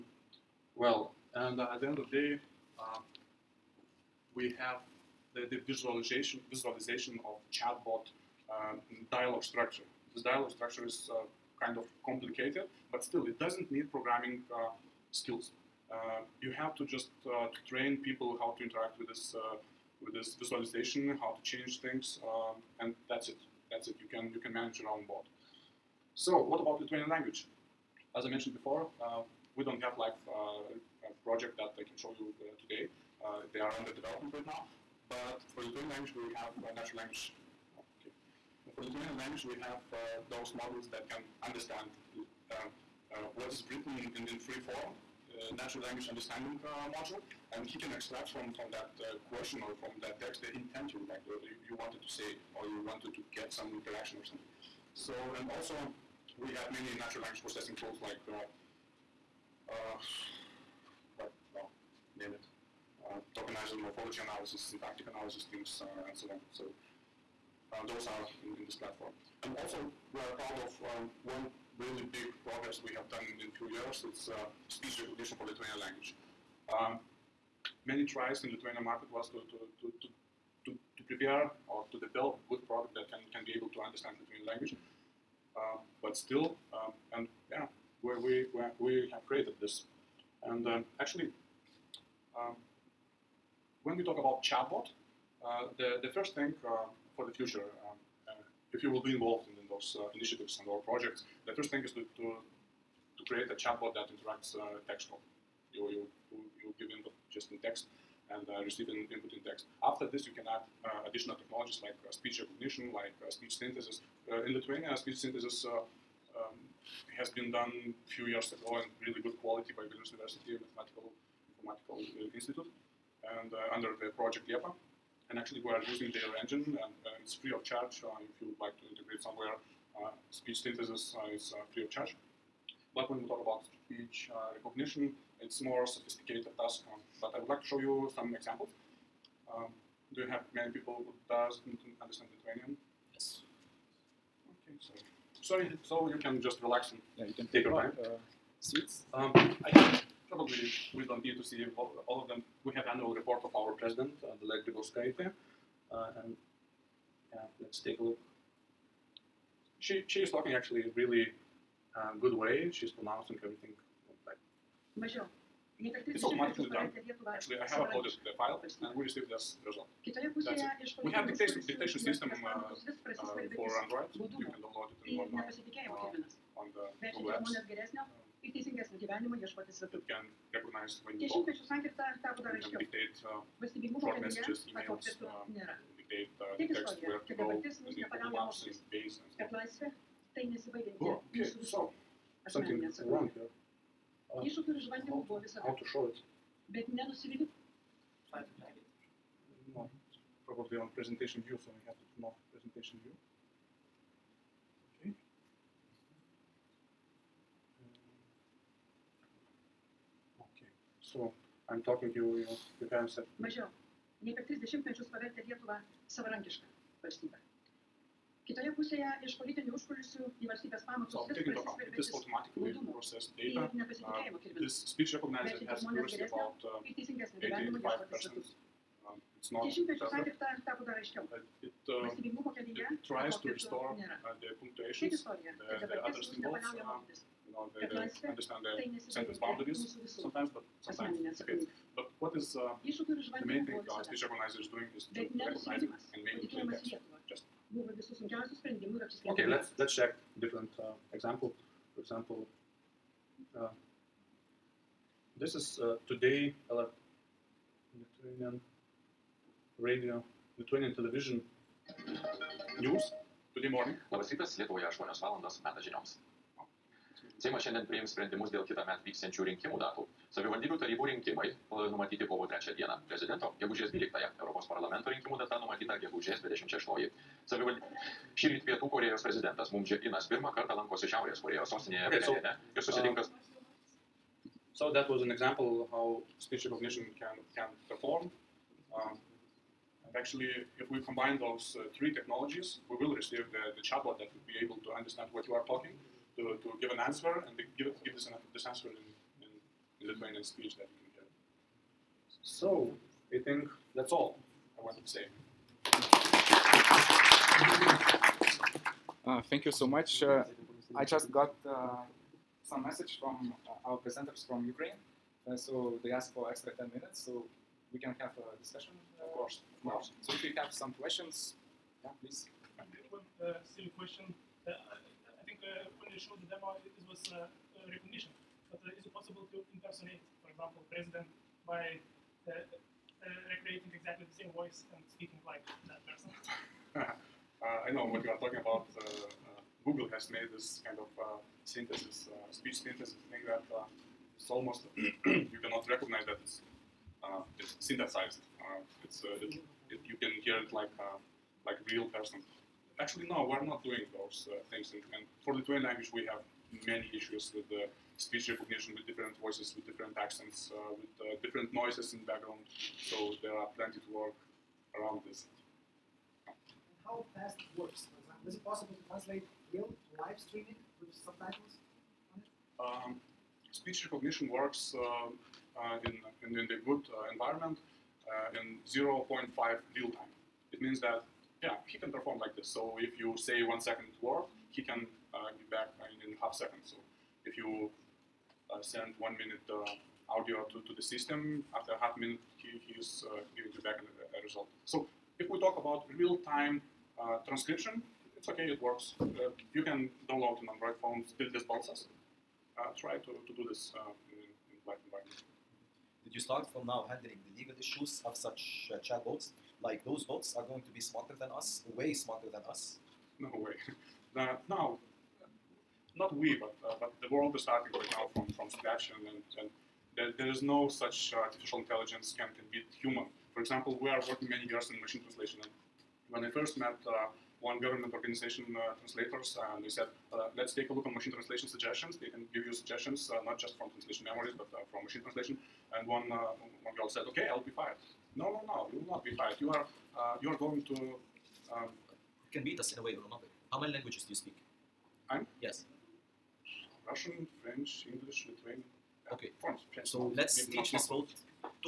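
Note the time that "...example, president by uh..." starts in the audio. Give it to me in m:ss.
5:30.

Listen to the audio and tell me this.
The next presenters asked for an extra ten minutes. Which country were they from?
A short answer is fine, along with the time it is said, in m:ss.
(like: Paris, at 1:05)
Ukraine, at 5:14.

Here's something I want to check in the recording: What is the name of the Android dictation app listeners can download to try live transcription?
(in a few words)
Tildes Balsas.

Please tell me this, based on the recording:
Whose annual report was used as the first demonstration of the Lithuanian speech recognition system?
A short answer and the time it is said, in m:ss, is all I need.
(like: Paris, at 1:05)
Dalia Grybauskaite, at 2:34.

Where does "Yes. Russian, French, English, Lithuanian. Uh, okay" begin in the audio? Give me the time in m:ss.
7:25.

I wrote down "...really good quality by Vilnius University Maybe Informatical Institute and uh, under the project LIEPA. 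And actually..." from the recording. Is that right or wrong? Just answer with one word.
wrong.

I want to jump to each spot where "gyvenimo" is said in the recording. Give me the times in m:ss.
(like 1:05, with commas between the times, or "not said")
2:59, 3:47.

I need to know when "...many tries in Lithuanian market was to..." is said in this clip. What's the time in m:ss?
1:17.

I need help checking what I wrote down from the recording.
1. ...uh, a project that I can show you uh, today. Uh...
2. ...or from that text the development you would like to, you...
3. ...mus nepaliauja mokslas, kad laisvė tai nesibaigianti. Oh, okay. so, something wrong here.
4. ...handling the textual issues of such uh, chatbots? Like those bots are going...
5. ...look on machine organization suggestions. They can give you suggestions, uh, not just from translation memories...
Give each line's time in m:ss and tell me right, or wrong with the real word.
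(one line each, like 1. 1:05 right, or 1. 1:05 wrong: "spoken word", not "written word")
1. 0:30 right
2. 0:49 wrong: "intent", not "development"
3. 3:07 right
4. 6:47 wrong: "legal", not "textual"
5. 7:10 wrong: "translation", not "organization".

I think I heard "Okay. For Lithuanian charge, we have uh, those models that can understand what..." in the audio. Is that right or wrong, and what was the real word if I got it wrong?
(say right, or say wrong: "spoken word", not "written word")
wrong: "language", not "charge".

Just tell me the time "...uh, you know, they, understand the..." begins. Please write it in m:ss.
3:56.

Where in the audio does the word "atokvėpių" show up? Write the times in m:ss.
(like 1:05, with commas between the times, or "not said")
3:04.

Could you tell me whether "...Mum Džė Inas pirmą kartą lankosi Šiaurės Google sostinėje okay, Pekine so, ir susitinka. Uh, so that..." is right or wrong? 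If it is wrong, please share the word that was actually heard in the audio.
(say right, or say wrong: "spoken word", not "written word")
wrong: "Korejos", not "Google".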